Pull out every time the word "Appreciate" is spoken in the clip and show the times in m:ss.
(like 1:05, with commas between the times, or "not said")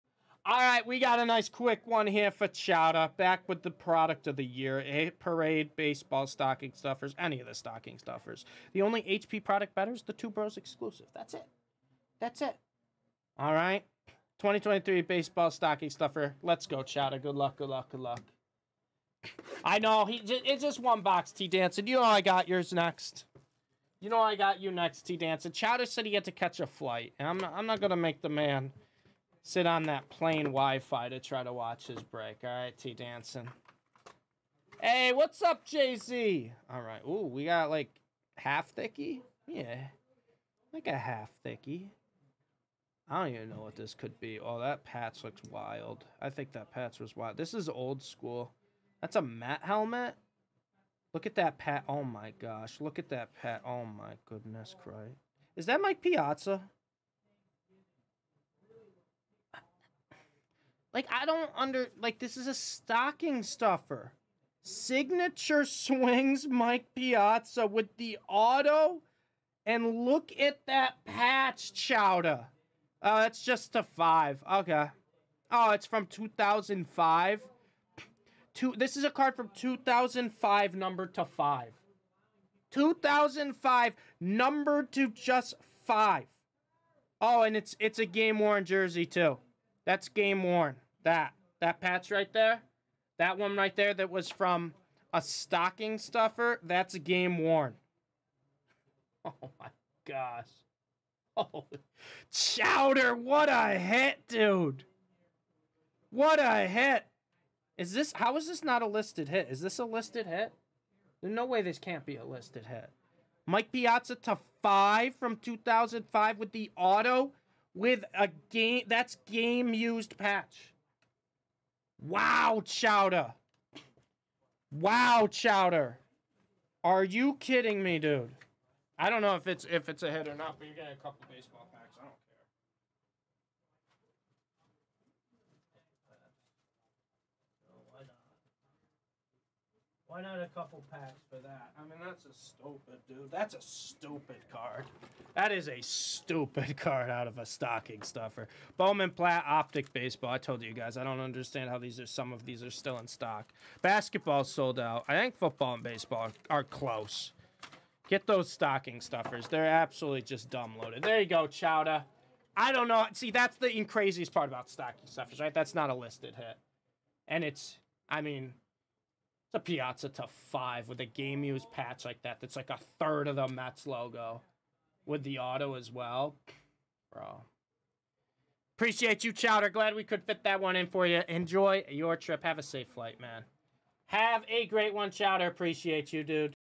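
2:58, 3:05.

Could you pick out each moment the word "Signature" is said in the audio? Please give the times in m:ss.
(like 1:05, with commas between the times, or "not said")
1:04.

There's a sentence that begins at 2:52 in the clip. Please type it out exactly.
That's like a third of the Mets logo with the auto as well.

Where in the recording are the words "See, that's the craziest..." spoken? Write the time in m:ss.
2:43.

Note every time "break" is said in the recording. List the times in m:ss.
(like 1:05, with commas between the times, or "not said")
0:32.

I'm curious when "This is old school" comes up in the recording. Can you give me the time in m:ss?
0:47.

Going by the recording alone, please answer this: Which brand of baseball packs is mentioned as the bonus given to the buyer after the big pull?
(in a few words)
Bowman.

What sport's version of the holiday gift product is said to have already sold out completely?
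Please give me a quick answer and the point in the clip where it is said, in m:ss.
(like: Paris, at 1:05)
Basketball, at 2:33.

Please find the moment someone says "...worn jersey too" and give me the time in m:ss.
1:28.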